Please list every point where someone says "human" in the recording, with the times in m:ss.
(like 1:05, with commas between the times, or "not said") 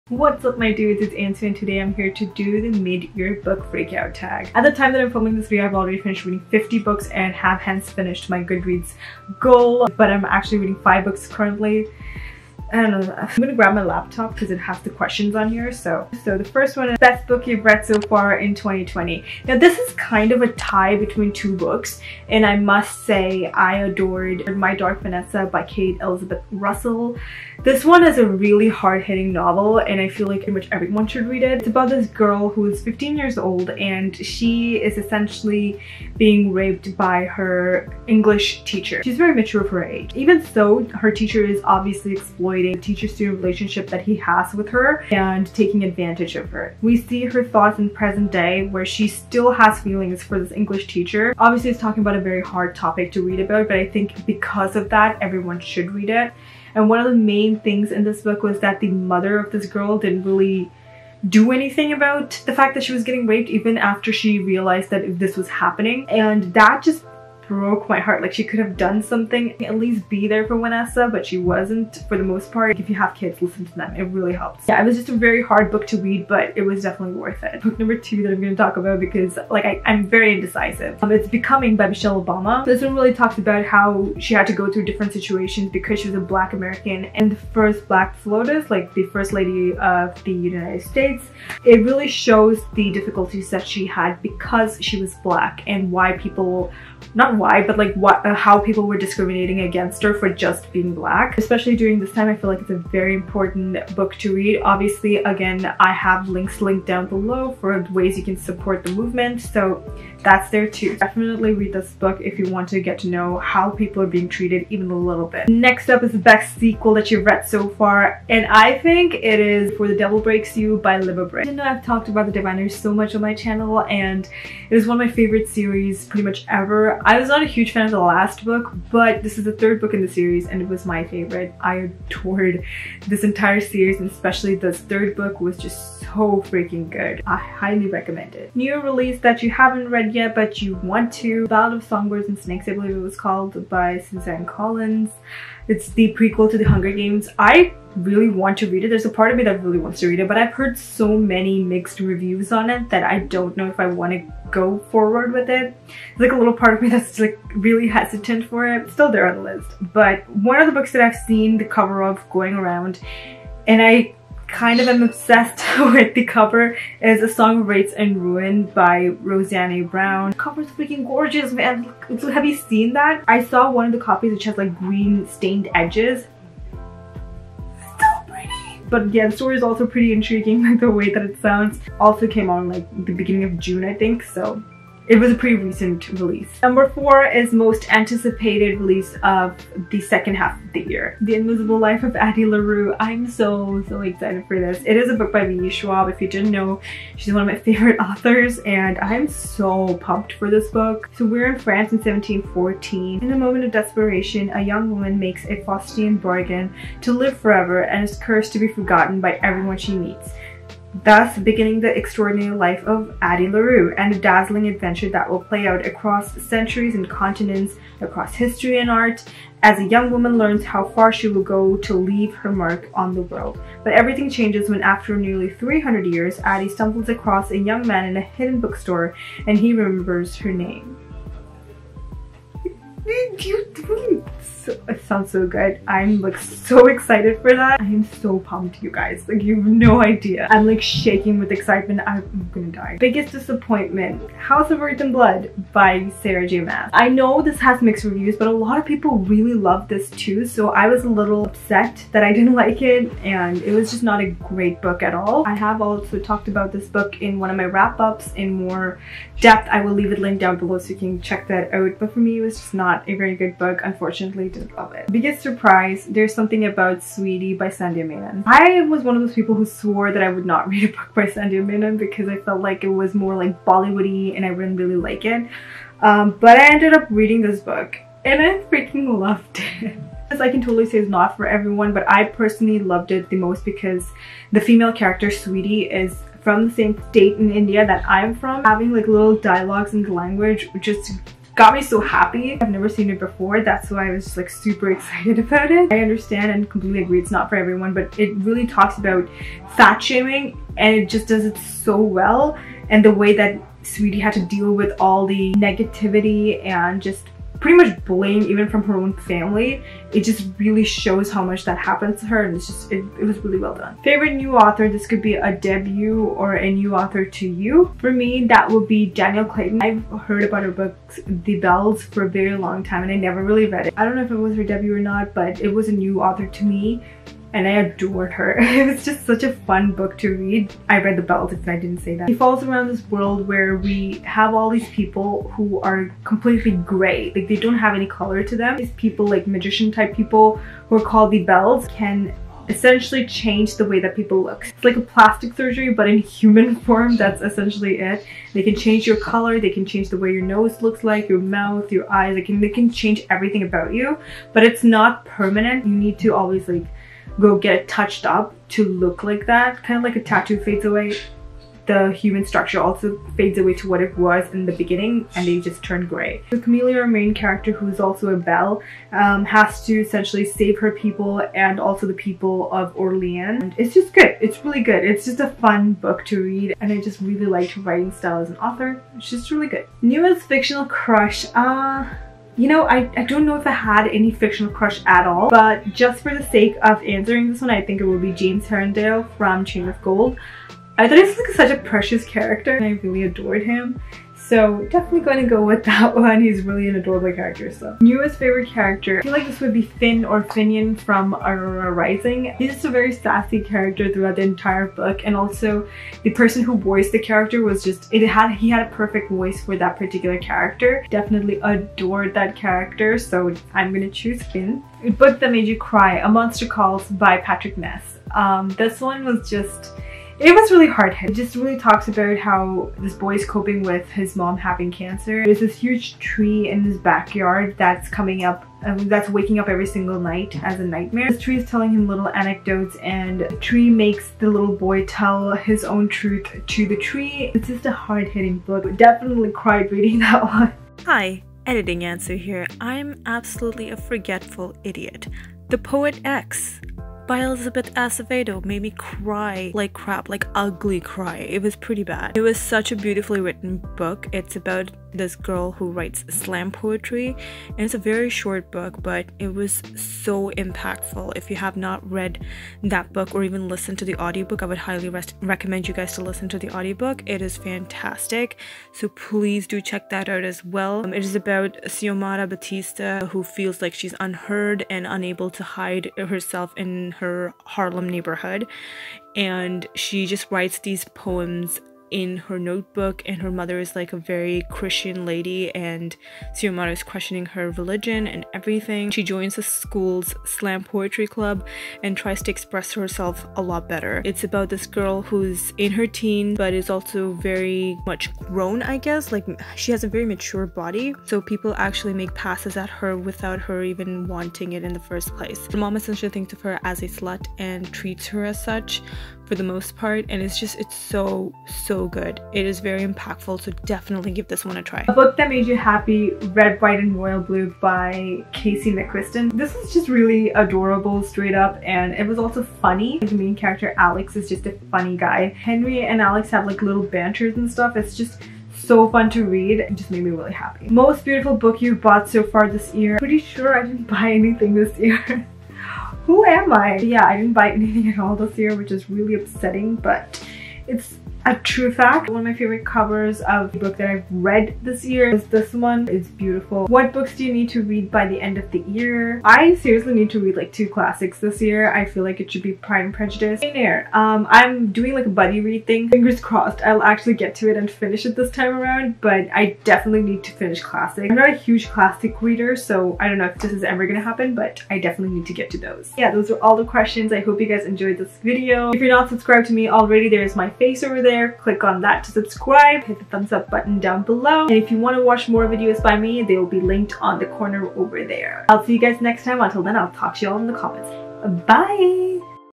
5:46, 6:02.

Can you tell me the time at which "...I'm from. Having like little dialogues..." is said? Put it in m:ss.
4:48.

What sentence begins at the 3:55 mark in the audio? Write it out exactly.
I'm like so excited for that.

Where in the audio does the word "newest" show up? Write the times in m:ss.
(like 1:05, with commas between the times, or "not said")
6:20, 6:38.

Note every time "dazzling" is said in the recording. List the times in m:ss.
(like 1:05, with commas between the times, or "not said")
3:34.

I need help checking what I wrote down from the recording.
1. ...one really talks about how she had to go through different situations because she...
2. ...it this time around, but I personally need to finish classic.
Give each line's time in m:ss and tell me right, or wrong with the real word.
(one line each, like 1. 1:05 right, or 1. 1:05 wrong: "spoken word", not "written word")
1. 1:22 right
2. 9:18 wrong: "definitely", not "personally".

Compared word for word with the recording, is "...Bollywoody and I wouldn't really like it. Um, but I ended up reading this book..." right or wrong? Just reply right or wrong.
right.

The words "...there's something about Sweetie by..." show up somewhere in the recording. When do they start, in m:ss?
4:26.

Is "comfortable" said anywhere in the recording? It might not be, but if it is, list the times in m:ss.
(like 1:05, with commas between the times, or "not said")
not said.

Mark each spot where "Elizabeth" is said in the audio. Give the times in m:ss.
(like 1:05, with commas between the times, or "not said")
0:25, 7:27.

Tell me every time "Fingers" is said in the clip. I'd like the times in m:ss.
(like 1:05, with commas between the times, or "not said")
9:16.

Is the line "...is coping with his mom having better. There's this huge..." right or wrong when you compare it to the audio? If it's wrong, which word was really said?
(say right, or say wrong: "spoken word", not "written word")
wrong: "cancer", not "better".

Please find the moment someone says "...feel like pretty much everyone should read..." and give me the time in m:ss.
0:30.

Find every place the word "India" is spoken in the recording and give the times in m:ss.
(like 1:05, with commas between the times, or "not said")
4:47.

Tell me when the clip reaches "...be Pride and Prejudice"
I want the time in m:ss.
9:12.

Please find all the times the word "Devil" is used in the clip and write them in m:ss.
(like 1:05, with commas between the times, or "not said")
1:59.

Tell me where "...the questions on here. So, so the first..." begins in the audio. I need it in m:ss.
0:14.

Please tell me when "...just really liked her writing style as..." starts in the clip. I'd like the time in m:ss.
6:17.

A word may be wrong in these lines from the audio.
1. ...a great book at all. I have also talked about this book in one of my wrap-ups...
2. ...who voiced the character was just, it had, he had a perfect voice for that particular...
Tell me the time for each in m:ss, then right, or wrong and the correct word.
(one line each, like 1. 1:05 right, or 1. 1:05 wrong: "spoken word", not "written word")
1. 4:14 right
2. 6:46 right.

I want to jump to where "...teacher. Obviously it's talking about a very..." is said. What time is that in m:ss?
0:50.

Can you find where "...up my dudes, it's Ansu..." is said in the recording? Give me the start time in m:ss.
0:00.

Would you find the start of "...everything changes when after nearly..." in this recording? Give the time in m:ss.
3:43.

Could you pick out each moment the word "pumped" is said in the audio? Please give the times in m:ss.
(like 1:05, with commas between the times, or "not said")
3:19, 3:58.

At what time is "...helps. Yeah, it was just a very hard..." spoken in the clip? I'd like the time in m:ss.
1:14.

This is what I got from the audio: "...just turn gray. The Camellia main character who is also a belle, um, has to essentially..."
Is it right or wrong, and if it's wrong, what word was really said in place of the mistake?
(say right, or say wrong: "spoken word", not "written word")
right.